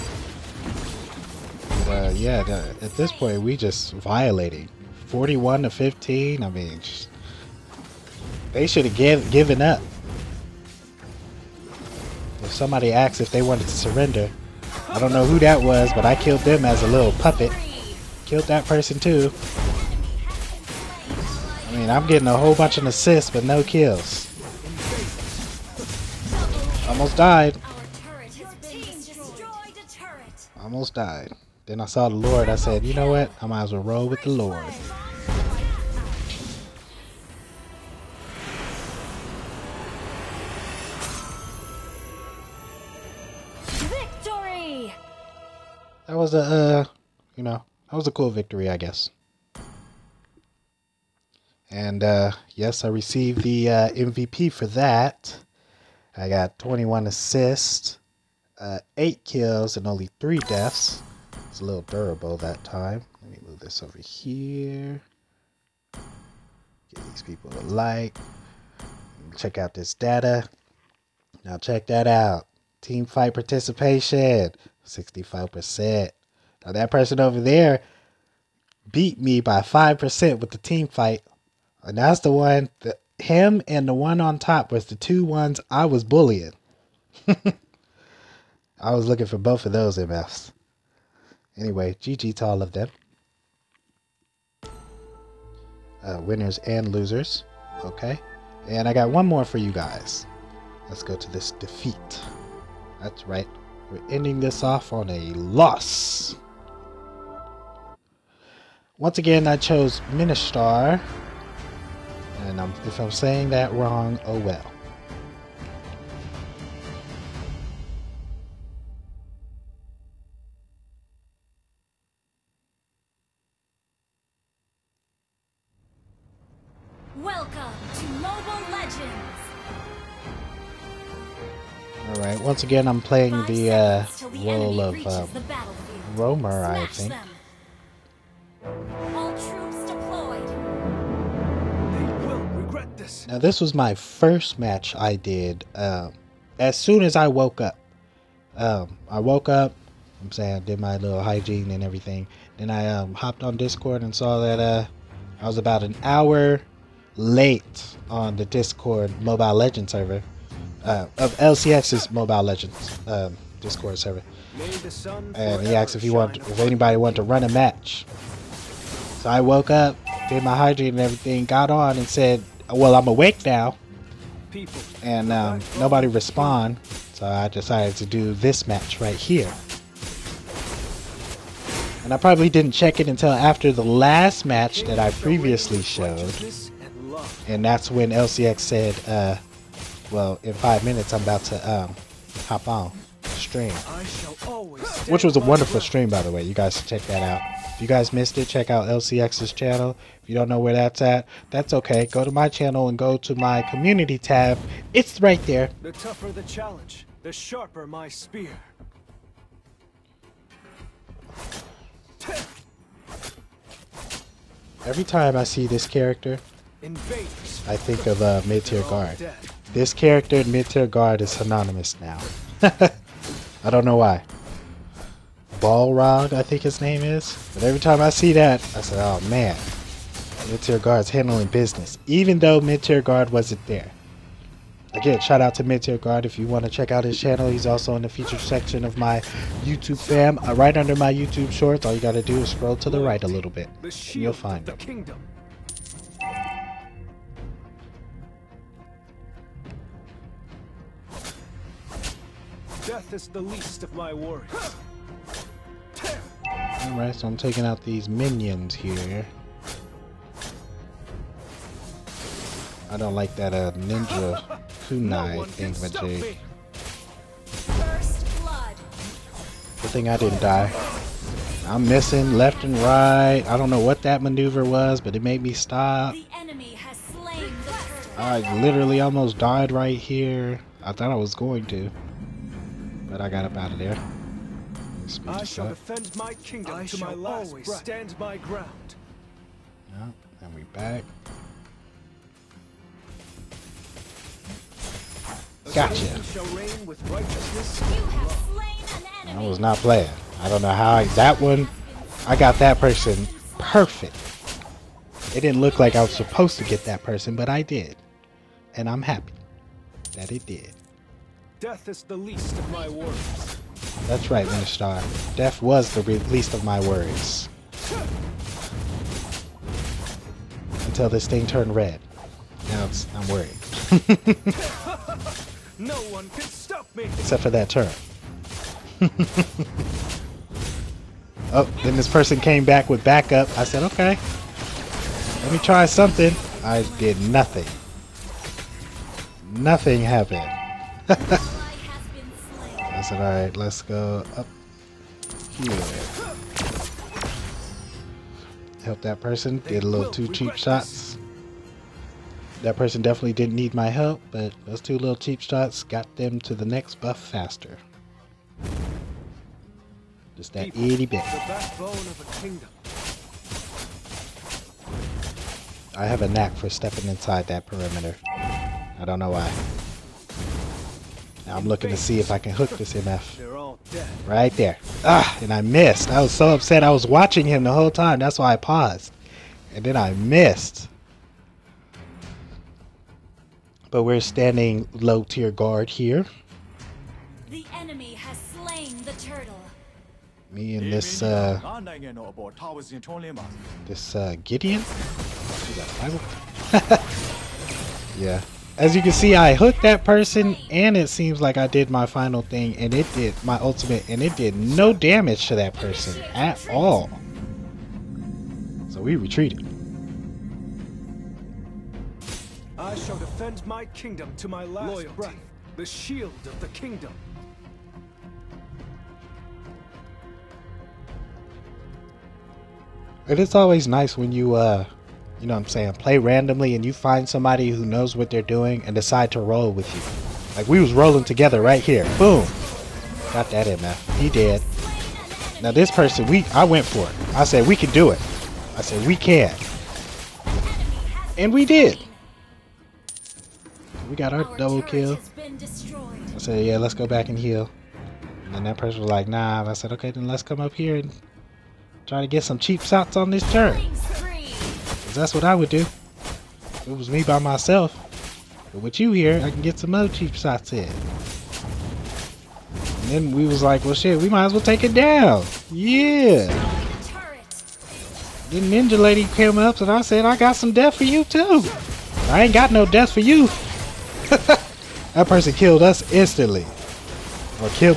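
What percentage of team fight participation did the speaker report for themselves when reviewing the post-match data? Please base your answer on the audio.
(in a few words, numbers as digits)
65%.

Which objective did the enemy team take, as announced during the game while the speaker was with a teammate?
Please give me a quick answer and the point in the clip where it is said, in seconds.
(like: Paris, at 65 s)
The turtle, at 389 s.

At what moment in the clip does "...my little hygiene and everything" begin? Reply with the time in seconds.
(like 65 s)
150 s.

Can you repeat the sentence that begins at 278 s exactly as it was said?
I literally almost died right here.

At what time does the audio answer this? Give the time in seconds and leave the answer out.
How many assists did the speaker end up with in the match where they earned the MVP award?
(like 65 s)
56 s.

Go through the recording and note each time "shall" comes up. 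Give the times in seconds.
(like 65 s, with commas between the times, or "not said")
285 s, 412 s.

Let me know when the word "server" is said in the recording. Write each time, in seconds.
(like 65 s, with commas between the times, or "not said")
159 s, 163 s.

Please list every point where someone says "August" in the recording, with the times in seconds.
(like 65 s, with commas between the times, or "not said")
not said.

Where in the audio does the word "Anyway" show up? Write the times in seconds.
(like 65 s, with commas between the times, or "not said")
91 s.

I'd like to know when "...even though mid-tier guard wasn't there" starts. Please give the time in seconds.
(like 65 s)
232 s.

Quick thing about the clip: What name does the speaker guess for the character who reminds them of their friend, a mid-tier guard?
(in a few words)
Balrog.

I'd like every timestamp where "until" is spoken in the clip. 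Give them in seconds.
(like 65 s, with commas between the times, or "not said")
183 s, 320 s.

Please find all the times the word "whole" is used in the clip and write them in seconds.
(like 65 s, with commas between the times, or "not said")
22 s, 377 s.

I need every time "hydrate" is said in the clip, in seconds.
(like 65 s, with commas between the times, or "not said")
170 s.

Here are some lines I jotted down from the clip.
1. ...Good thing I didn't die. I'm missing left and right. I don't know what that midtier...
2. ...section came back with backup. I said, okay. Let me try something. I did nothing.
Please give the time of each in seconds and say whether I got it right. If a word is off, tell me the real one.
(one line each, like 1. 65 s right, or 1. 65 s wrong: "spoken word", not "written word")
1. 269 s wrong: "maneuver", not "midtier"
2. 332 s wrong: "person", not "section".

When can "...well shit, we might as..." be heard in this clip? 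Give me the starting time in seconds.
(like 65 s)
463 s.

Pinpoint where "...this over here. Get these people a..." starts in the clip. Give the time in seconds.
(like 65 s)
63 s.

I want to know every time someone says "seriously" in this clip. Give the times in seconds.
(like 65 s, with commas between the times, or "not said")
not said.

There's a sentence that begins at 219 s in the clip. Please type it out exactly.
This character mid-tier guard is synonymous now.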